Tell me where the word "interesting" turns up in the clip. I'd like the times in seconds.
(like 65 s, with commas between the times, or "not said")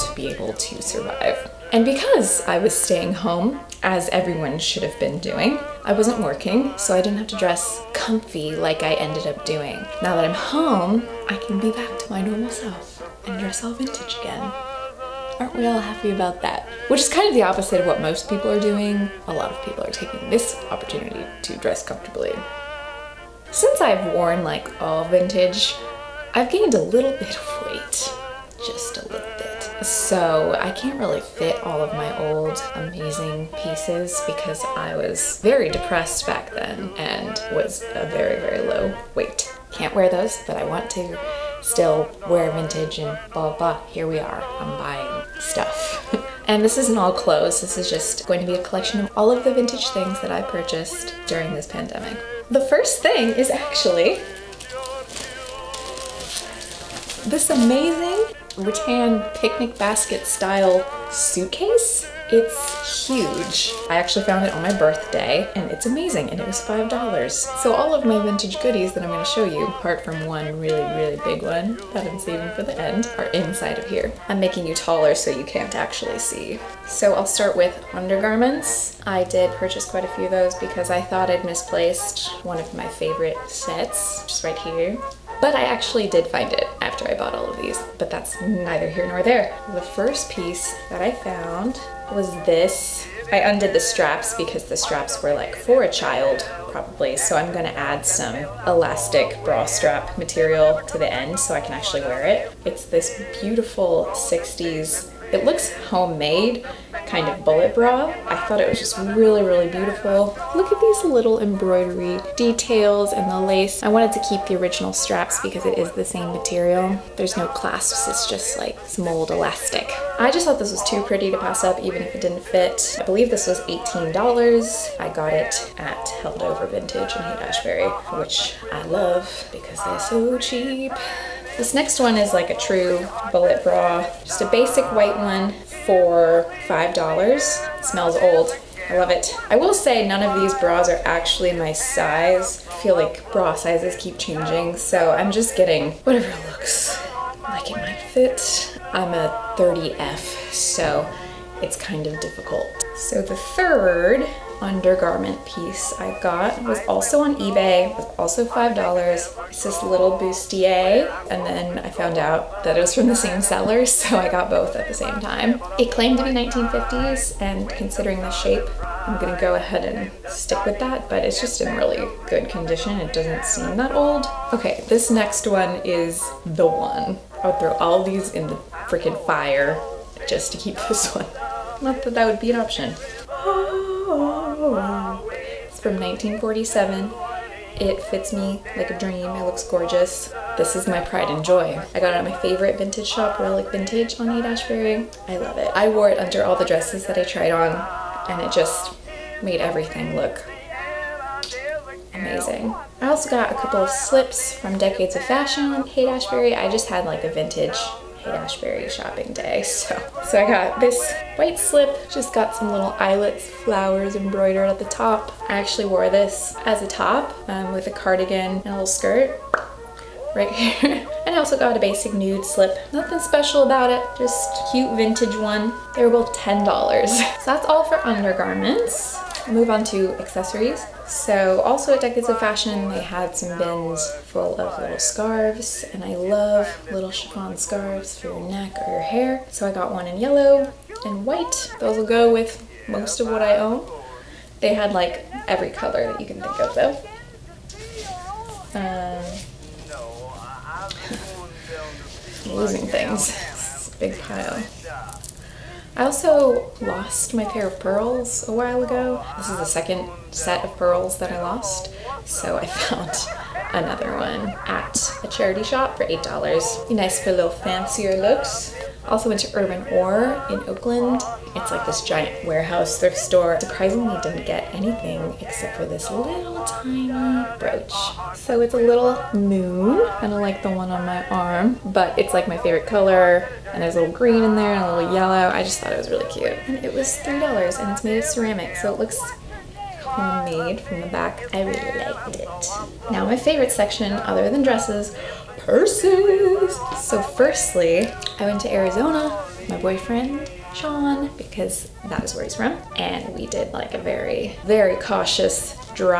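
not said.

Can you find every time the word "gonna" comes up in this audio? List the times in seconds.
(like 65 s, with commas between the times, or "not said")
69 s, 97 s, 169 s.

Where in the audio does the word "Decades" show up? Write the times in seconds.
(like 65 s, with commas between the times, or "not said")
204 s, 232 s.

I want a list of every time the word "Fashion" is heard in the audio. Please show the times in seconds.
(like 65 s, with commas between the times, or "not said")
205 s, 232 s.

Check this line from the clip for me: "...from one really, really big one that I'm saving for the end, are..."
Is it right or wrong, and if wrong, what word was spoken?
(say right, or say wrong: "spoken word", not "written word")
right.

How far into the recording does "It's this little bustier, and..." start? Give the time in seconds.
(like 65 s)
159 s.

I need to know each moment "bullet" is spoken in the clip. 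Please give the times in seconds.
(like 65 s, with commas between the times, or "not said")
107 s, 133 s.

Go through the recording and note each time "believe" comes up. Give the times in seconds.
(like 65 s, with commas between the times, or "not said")
123 s.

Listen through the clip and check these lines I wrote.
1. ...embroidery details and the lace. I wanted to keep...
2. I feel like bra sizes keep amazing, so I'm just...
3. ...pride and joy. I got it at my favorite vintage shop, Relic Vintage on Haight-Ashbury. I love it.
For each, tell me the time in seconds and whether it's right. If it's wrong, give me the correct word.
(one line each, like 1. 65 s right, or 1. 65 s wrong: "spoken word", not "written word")
1. 111 s right
2. 142 s wrong: "changing", not "amazing"
3. 190 s right.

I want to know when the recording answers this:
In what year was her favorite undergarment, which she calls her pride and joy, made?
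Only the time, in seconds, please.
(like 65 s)
185 s.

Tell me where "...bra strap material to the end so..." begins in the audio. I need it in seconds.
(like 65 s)
99 s.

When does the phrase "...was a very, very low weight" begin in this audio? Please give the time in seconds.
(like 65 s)
37 s.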